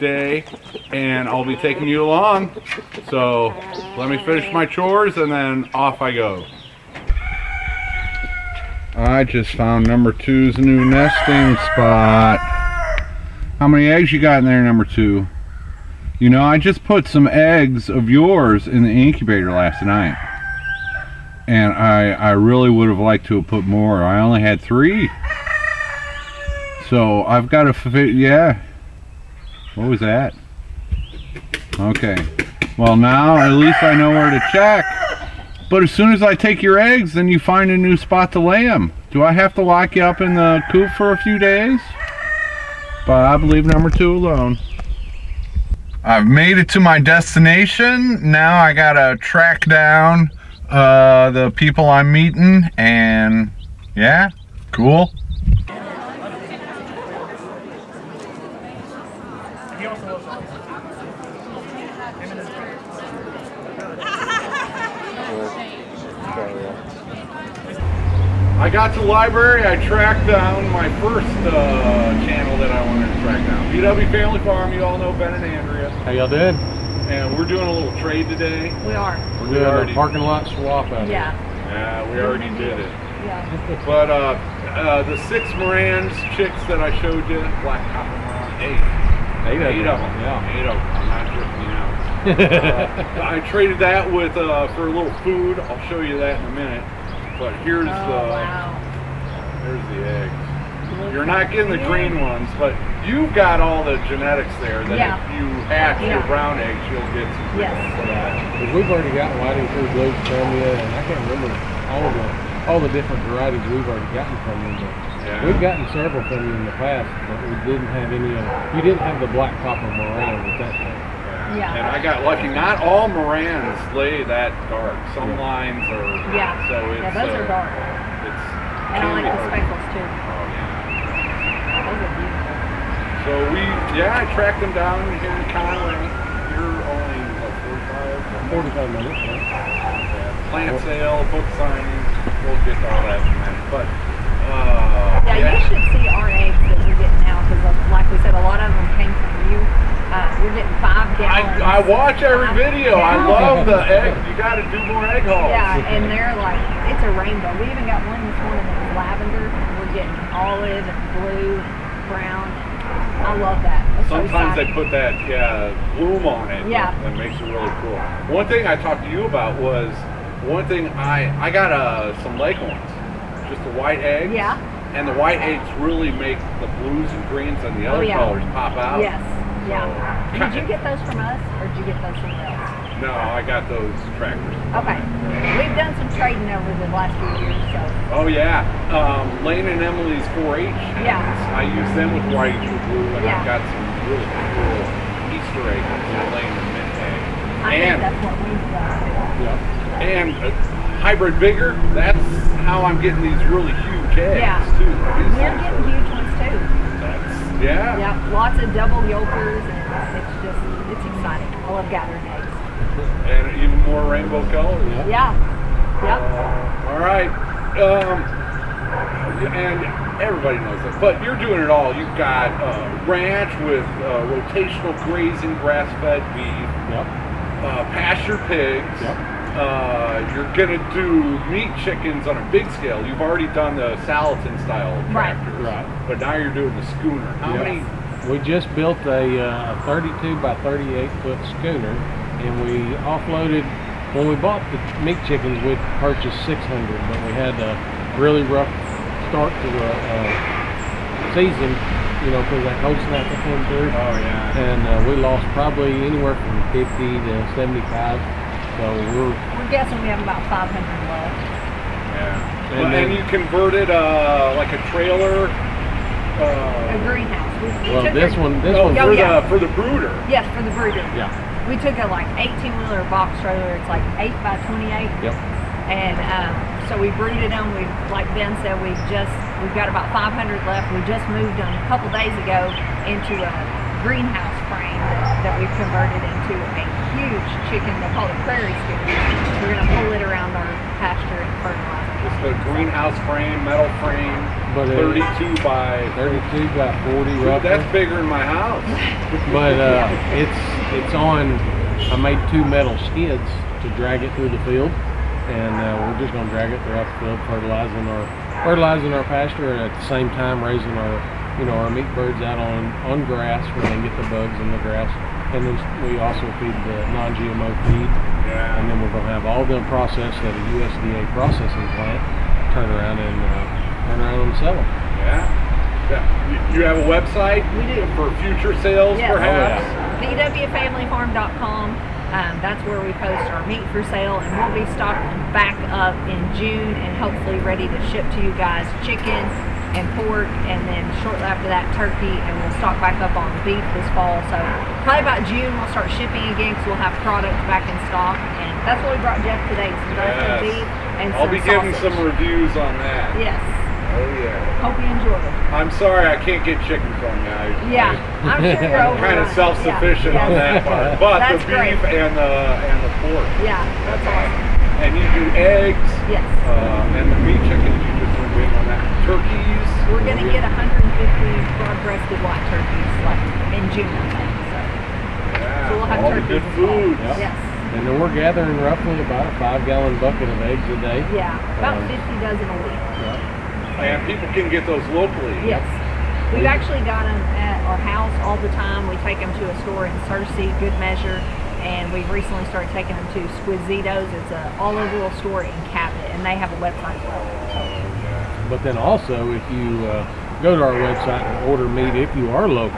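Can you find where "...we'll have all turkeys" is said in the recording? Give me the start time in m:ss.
6:16.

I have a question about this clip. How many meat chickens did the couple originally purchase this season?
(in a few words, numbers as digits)
600.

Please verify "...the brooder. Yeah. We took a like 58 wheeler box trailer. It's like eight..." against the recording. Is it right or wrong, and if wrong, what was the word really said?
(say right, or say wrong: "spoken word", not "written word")
wrong: "18", not "58".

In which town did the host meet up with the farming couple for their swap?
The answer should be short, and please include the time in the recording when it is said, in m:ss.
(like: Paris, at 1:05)
Conway, at 2:15.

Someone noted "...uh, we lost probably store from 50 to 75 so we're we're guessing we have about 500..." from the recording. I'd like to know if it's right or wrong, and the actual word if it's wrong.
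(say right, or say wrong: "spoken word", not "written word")
wrong: "anywhere", not "store".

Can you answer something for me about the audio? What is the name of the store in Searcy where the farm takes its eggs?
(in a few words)
Good Measure.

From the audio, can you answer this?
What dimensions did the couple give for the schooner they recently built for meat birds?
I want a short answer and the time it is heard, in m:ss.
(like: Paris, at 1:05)
32 by 38 feet, at 3:59.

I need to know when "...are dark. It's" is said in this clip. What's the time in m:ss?
2:07.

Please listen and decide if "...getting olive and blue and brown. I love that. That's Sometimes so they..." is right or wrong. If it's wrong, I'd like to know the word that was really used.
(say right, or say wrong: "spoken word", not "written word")
right.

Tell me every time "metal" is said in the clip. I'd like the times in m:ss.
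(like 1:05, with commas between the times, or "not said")
4:53, 5:02.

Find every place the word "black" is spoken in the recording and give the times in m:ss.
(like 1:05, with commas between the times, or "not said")
1:27, 1:59.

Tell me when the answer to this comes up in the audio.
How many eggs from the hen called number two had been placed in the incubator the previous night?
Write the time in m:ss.
0:24.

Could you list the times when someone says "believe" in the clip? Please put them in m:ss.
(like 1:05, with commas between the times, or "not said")
0:43.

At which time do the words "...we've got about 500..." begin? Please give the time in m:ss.
4:39.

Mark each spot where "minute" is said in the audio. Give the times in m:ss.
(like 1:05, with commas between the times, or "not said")
1:36, 2:18, 2:23.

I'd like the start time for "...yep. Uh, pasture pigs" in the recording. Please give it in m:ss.
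3:46.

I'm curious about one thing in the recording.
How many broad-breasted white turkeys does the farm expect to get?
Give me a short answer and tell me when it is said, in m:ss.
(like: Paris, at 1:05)
150, at 6:10.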